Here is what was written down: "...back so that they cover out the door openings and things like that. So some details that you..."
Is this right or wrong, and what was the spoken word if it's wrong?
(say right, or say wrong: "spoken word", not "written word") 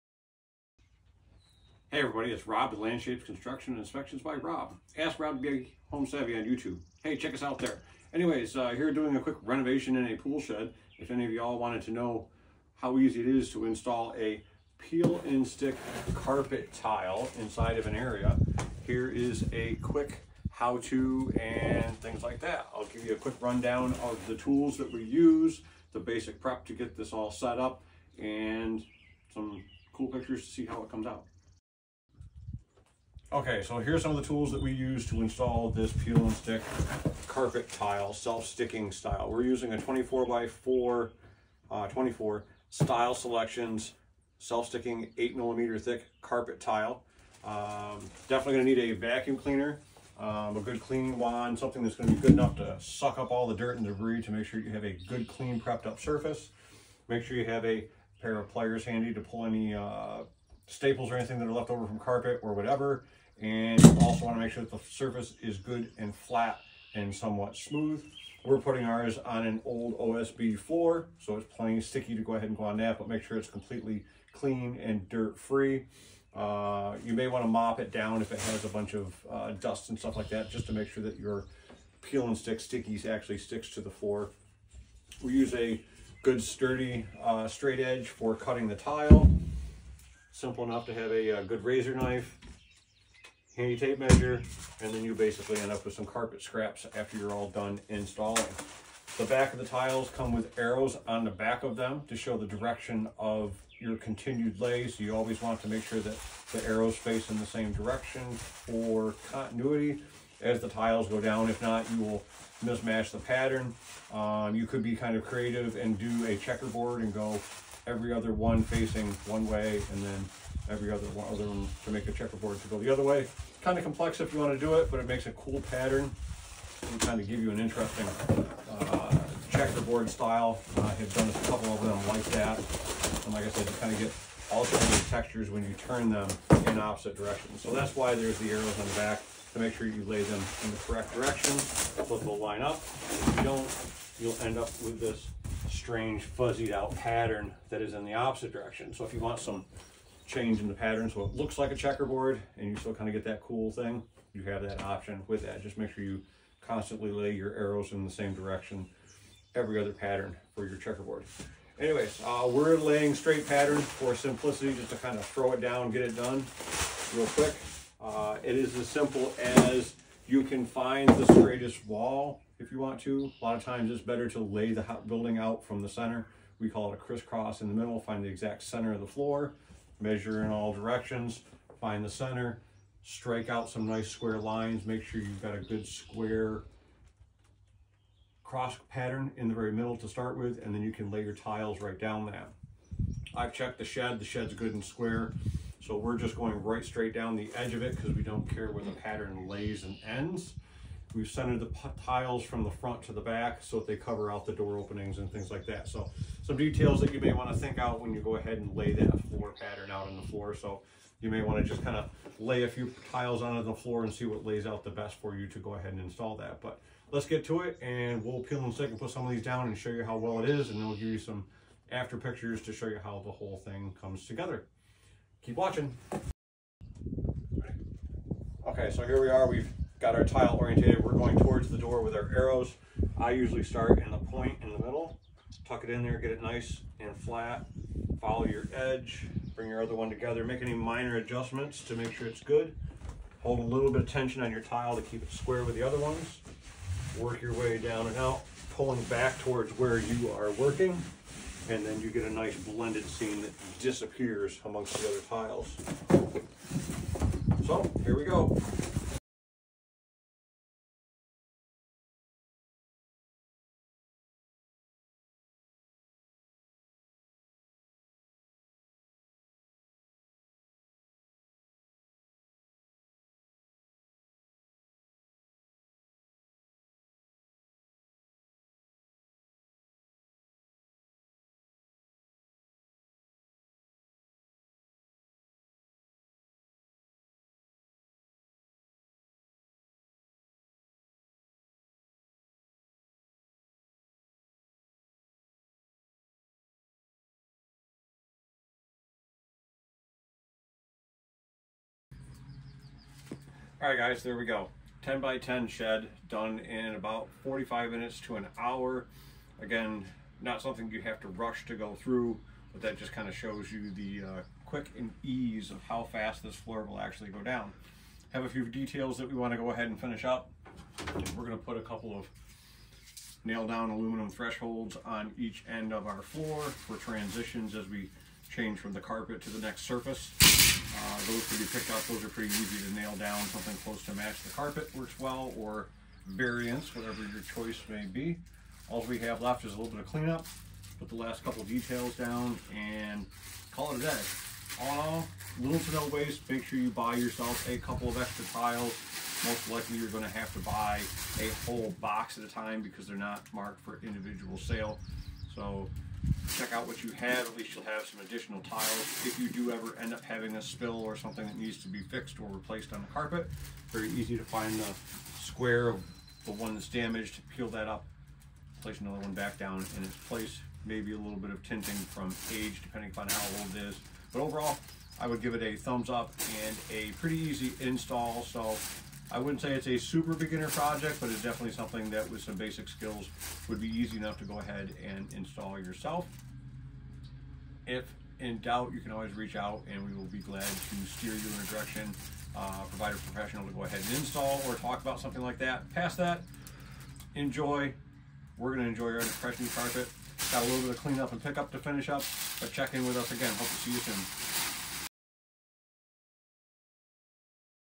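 right.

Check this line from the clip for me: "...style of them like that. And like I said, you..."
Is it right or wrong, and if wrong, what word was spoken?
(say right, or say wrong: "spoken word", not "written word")
wrong: "couple", not "style".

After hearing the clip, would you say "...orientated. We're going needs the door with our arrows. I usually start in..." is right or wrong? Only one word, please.
wrong.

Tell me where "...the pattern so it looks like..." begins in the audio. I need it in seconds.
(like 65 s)
150 s.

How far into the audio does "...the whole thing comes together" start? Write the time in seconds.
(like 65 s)
223 s.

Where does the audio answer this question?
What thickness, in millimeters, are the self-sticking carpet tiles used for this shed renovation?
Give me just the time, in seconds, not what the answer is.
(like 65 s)
45 s.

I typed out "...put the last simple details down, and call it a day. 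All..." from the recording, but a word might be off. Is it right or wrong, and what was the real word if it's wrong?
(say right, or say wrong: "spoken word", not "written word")
wrong: "couple", not "simple".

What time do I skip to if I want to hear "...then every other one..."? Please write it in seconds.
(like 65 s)
120 s.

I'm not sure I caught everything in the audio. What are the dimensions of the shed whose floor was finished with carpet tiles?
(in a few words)
10 by 10.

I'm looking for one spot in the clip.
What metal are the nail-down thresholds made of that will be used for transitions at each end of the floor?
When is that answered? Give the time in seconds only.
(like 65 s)
323 s.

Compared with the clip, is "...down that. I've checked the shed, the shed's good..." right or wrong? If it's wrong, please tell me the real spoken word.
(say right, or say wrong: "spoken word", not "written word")
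right.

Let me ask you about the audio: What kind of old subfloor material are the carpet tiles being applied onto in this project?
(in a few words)
OSB.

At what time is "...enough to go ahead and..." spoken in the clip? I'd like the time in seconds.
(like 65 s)
384 s.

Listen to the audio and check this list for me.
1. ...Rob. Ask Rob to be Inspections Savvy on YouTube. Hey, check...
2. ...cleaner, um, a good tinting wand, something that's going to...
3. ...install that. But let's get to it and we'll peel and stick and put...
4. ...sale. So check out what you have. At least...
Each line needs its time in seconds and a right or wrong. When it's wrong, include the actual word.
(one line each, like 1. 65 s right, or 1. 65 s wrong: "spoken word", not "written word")
1. 4 s wrong: "Home", not "Inspections"
2. 49 s wrong: "cleaning", not "tinting"
3. 216 s right
4. 354 s right.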